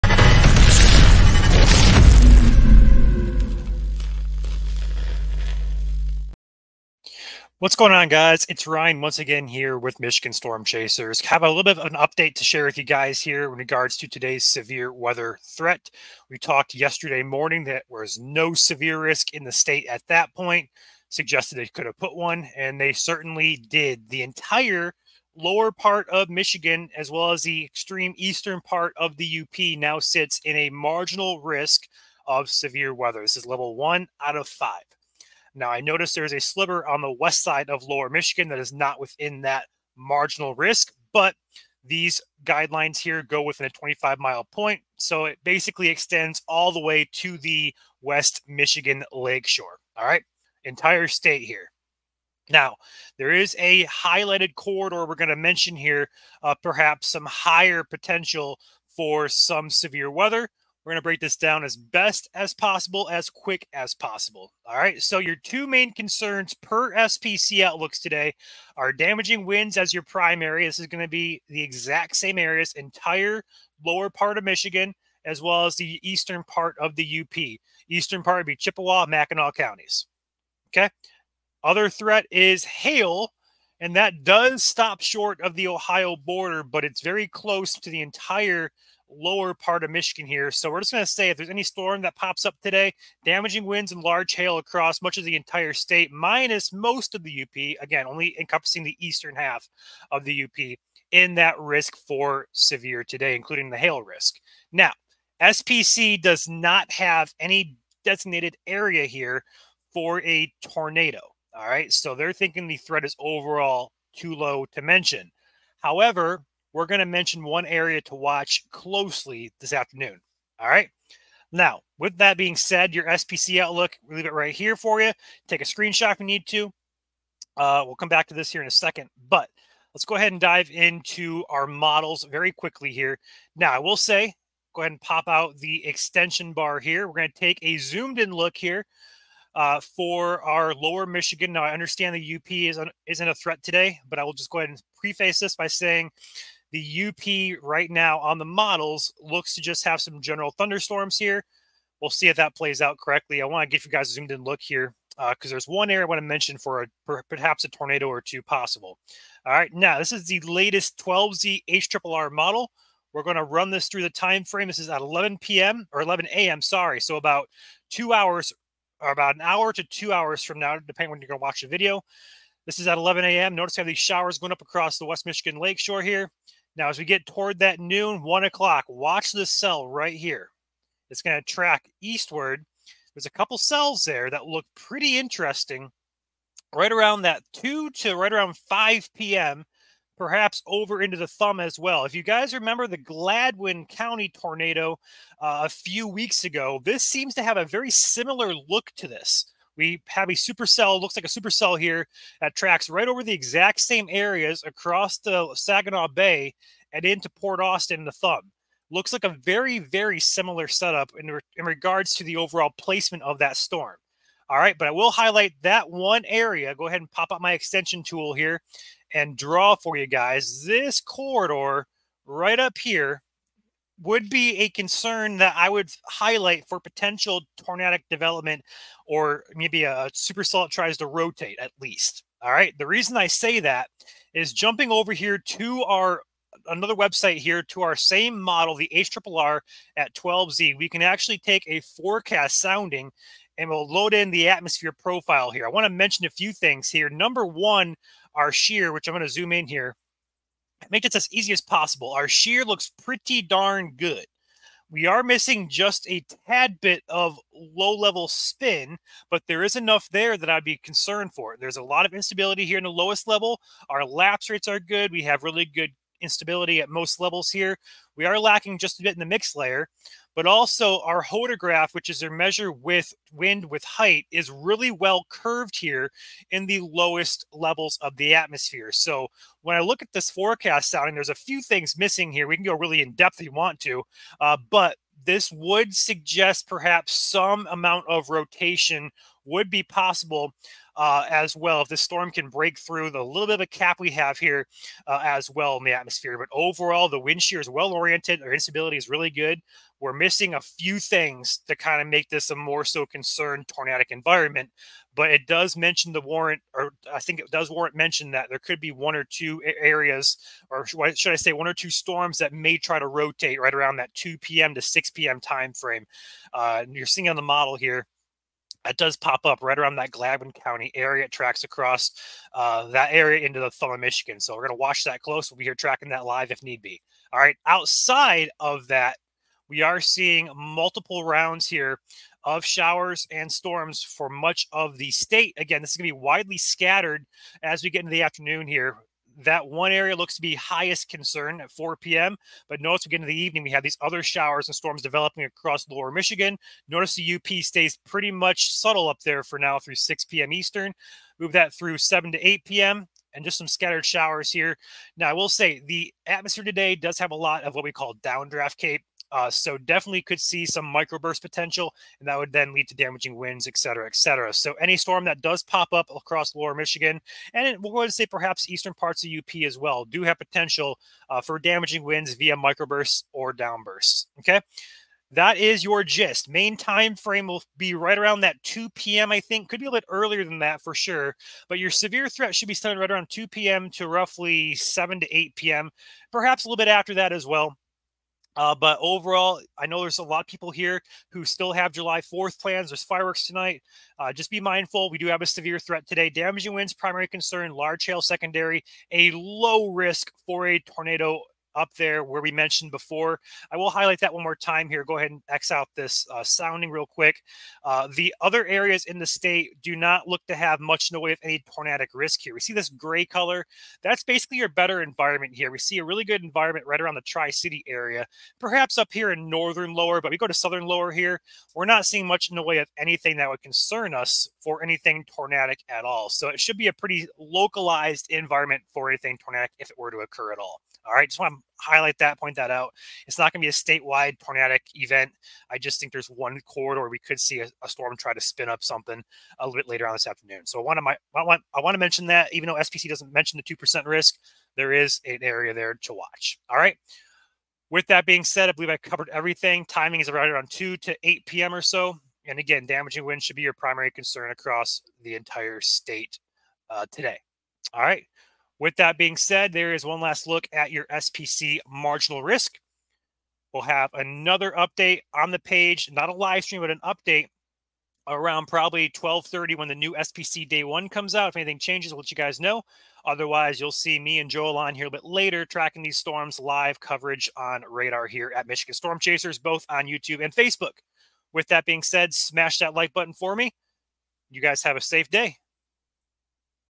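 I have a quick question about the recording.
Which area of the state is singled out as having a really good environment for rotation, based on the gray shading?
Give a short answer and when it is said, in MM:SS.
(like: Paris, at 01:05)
Tri-City area, at 06:57.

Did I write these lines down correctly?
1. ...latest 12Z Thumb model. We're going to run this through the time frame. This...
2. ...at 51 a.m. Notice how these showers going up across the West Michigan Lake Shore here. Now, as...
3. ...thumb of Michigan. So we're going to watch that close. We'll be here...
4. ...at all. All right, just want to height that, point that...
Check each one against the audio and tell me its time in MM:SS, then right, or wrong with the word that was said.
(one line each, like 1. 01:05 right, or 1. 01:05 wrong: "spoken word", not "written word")
1. 02:40 wrong: "HRRR", not "Thumb"
2. 02:52 wrong: "11", not "51"
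3. 05:23 right
4. 07:10 wrong: "highlight", not "height".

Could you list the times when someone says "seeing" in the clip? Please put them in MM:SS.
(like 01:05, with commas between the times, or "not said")
05:17, 05:30, 07:02.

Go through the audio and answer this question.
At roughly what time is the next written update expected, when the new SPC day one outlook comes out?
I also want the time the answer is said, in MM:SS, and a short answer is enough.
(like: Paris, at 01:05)
12:30, at 07:49.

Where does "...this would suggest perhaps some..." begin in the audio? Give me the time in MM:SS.
04:45.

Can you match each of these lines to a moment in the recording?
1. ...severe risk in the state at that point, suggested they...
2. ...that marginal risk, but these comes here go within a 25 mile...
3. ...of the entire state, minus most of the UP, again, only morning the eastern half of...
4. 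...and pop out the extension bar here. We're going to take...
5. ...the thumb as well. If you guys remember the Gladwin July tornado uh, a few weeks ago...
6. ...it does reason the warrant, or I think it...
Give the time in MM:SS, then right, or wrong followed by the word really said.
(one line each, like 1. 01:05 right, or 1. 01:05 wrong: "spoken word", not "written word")
1. 00:18 right
2. 00:39 wrong: "guidelines", not "comes"
3. 01:35 wrong: "encompassing", not "morning"
4. 02:14 right
5. 03:11 wrong: "County", not "July"
6. 05:05 wrong: "mention", not "reason".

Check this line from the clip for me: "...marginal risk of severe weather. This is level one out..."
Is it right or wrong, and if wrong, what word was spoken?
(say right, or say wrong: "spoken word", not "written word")
right.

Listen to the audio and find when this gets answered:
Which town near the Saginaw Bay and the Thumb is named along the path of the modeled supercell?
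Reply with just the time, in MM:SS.
03:27.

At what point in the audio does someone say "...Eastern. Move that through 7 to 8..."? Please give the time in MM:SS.
05:50.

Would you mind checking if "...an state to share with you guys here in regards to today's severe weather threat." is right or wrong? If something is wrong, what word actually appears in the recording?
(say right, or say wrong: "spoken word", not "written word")
wrong: "update", not "state".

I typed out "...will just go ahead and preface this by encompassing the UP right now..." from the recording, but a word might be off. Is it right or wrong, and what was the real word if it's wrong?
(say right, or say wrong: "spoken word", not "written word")
wrong: "saying", not "encompassing".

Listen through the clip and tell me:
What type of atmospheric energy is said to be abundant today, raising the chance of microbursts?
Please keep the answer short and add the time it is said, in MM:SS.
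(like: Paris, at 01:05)
Downdraft CAPE, at 05:58.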